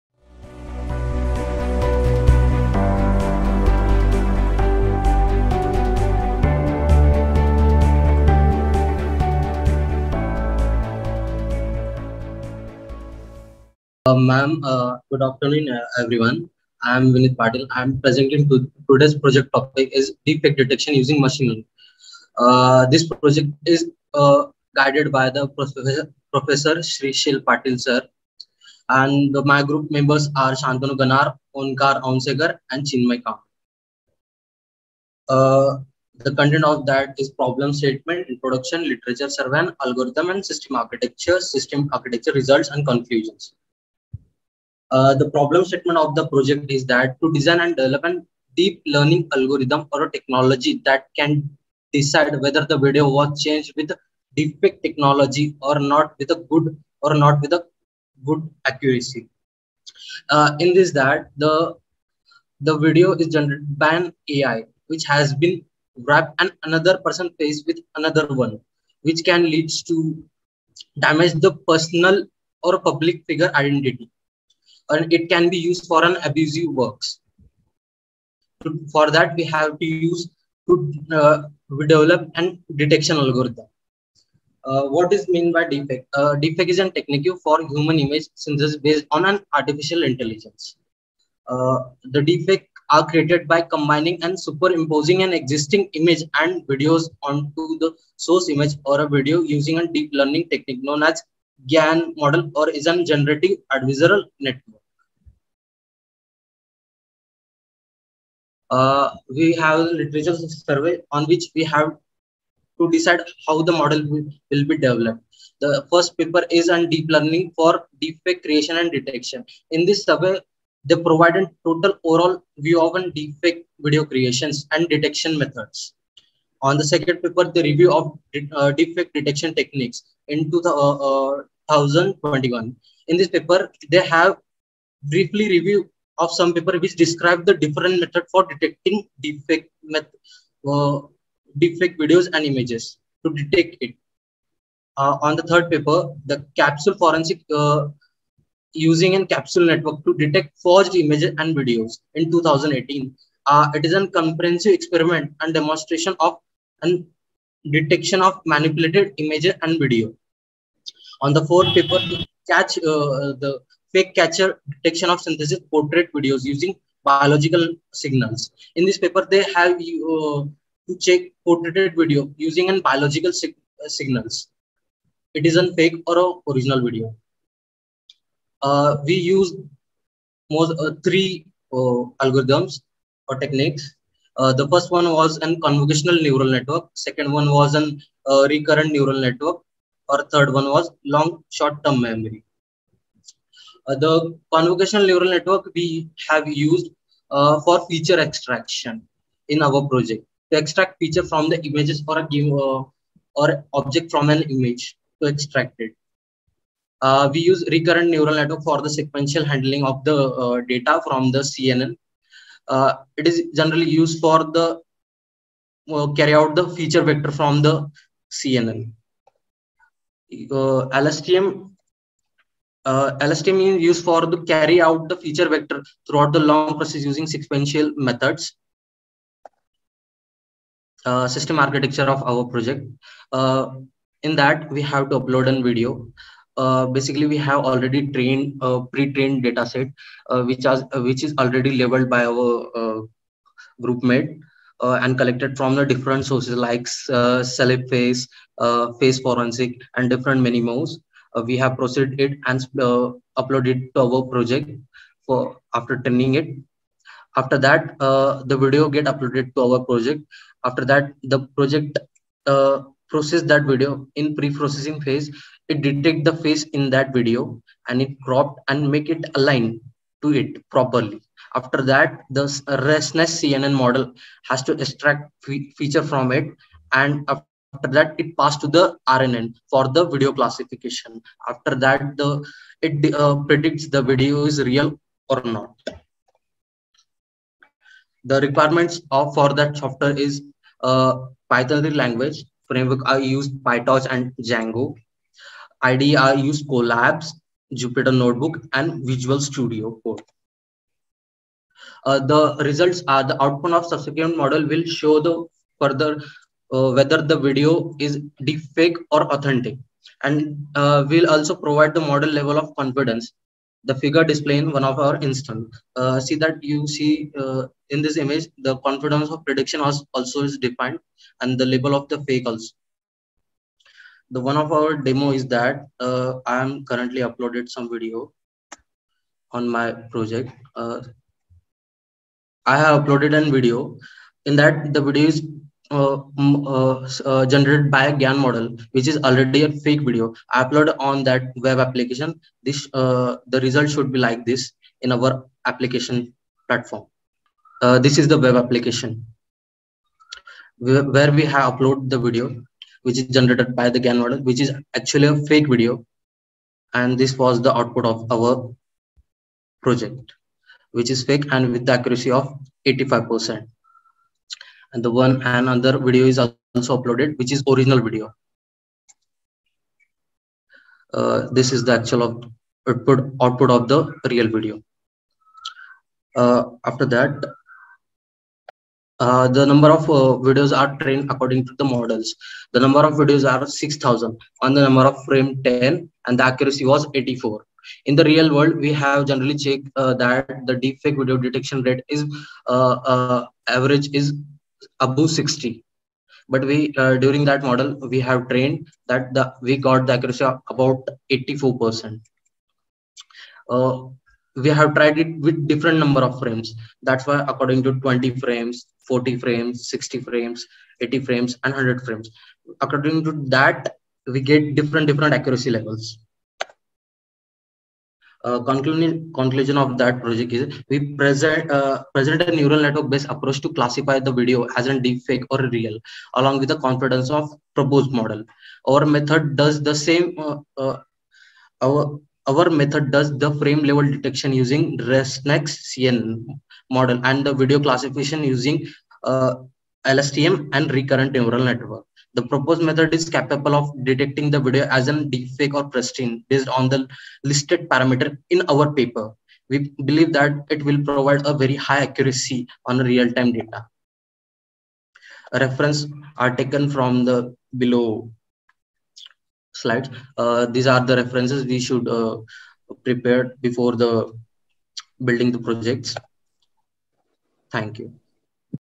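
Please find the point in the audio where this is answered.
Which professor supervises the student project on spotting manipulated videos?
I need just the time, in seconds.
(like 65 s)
26 s.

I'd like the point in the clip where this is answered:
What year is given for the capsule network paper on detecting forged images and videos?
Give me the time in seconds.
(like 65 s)
152 s.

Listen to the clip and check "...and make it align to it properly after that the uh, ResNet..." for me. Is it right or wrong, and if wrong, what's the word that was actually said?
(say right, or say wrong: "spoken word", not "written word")
right.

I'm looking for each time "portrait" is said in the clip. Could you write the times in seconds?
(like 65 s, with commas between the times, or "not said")
165 s, 171 s.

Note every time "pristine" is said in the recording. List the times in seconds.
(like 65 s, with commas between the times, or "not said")
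445 s.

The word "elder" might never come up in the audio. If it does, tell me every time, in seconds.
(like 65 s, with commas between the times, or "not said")
not said.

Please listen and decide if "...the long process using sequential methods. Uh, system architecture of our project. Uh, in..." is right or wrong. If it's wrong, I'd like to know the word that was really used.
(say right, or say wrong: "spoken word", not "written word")
right.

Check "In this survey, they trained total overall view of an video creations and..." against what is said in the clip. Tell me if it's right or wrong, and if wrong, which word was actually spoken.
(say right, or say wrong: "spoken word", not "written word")
wrong: "provided", not "trained".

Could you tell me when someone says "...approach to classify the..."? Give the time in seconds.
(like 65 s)
423 s.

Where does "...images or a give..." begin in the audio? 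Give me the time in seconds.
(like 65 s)
201 s.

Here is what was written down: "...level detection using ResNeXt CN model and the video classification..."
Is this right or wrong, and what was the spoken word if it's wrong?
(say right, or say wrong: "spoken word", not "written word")
right.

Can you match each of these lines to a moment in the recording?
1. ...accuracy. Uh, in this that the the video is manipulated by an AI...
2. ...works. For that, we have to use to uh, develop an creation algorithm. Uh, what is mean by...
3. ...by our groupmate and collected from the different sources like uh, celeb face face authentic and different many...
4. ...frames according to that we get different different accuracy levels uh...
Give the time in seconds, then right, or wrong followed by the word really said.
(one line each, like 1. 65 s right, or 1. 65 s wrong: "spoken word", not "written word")
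1. 58 s wrong: "generated", not "manipulated"
2. 76 s wrong: "detection", not "creation"
3. 242 s wrong: "forensic", not "authentic"
4. 412 s right.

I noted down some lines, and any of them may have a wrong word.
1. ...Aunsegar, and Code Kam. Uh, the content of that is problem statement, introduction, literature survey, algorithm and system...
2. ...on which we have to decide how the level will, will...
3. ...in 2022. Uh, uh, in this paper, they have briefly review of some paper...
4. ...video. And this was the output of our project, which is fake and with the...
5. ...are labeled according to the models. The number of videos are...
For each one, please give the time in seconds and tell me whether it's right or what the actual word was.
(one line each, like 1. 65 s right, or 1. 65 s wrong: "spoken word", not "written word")
1. 32 s wrong: "Chinmay", not "Code"
2. 111 s wrong: "model", not "level"
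3. 130 s wrong: "2021", not "2022"
4. 355 s right
5. 380 s wrong: "trained", not "labeled".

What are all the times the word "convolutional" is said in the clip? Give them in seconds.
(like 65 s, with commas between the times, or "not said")
185 s, 194 s.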